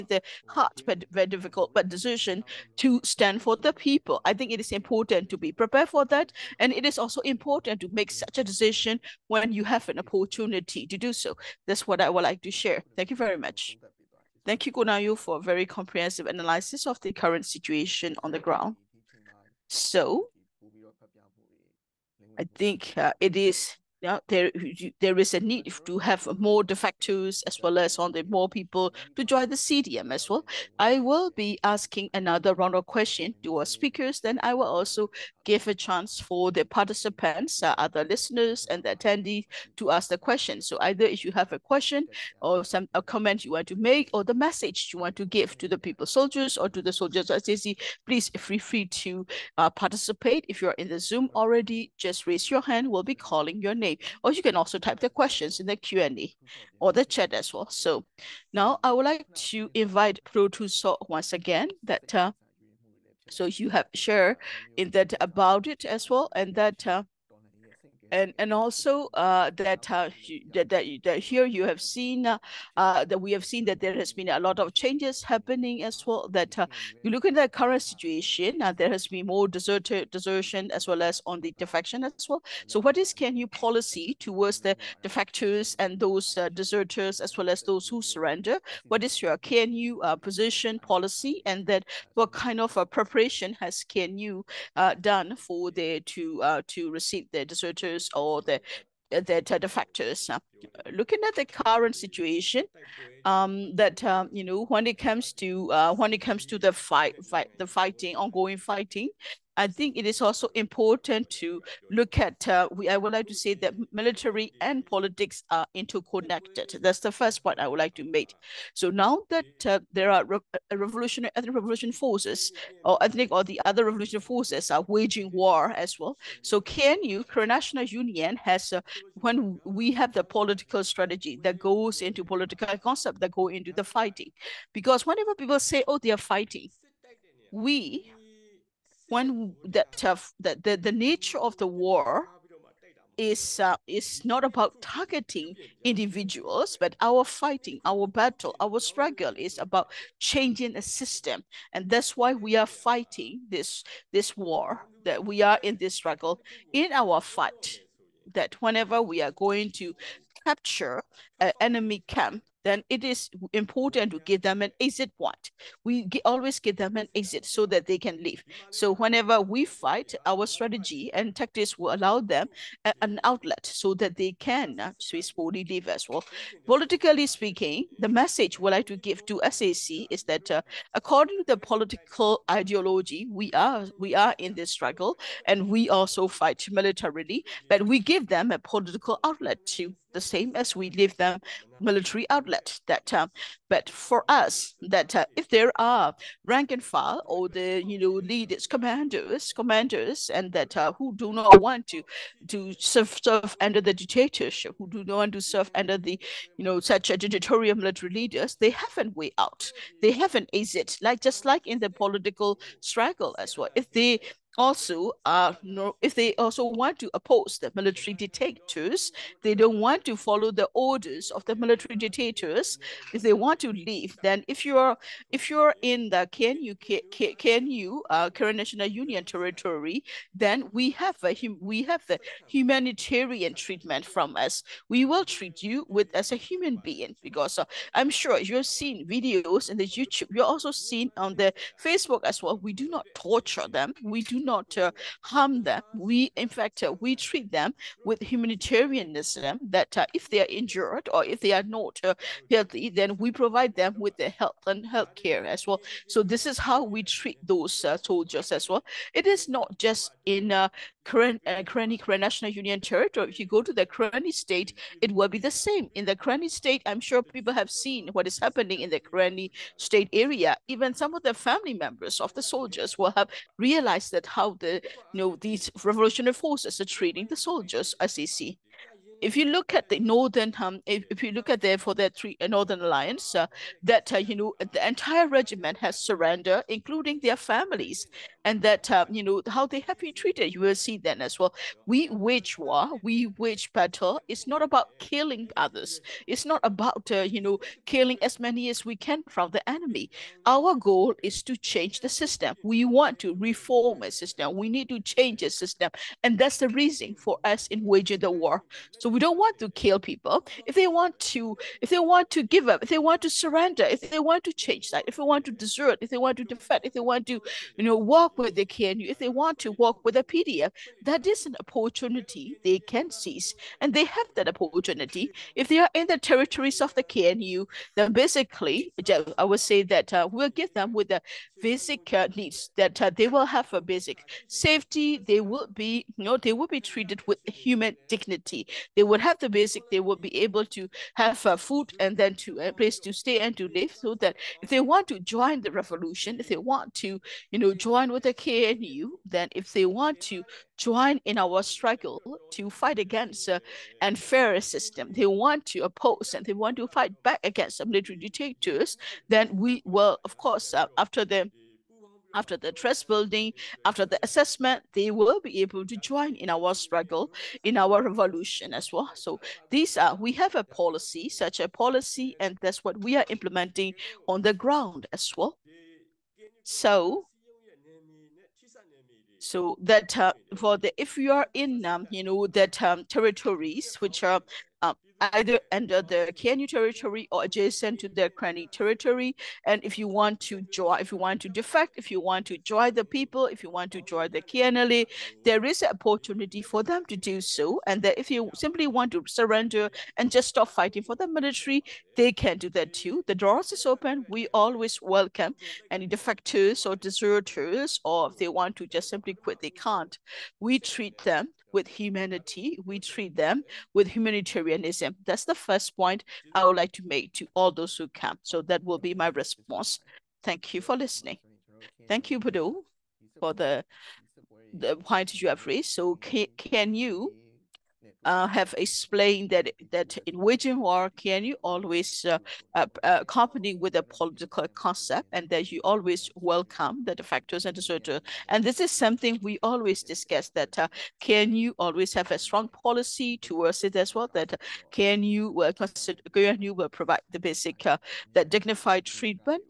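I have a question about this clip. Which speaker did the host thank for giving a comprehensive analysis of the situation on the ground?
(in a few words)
Ko Naung Yoe.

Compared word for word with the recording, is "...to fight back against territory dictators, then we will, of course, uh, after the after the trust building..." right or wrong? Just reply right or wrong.
wrong.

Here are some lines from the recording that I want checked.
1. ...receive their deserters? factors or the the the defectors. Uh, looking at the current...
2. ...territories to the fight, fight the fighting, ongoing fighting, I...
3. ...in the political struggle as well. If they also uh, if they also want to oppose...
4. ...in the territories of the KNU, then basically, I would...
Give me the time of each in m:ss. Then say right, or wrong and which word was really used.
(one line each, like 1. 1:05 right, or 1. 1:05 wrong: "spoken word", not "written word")
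1. 1:36 wrong: "factors", not "defectors"
2. 1:46 wrong: "comes", not "territories"
3. 3:31 right
4. 5:25 right.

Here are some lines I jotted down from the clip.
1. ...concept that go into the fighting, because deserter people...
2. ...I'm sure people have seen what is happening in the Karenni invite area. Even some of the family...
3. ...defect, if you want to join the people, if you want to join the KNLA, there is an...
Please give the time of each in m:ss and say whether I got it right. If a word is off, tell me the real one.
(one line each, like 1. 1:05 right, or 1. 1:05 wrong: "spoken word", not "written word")
1. 2:12 wrong: "whenever", not "deserter"
2. 4:26 wrong: "state", not "invite"
3. 6:31 right.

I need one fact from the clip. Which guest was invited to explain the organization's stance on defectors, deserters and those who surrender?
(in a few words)
Padoh Htoo Saw.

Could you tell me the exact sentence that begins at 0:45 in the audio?
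people soldiers or to the soldiers SAC, please feel free to uh, participate.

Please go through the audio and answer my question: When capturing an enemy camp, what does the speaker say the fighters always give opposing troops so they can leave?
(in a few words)
An exit point.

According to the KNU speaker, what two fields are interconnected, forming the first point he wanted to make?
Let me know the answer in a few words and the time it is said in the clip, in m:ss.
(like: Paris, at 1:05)
Military and politics, at 1:53.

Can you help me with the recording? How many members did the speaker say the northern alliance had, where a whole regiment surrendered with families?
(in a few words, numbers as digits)
3.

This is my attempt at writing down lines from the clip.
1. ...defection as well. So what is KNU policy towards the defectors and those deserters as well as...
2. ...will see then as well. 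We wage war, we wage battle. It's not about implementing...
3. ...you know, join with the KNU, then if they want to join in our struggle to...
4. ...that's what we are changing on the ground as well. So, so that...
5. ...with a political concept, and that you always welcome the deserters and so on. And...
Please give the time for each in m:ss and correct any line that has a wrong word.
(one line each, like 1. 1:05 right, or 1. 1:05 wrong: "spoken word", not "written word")
1. 1:21 right
2. 4:50 wrong: "killing", not "implementing"
3. 5:47 right
4. 6:12 wrong: "implementing", not "changing"
5. 7:13 wrong: "factors", not "deserters".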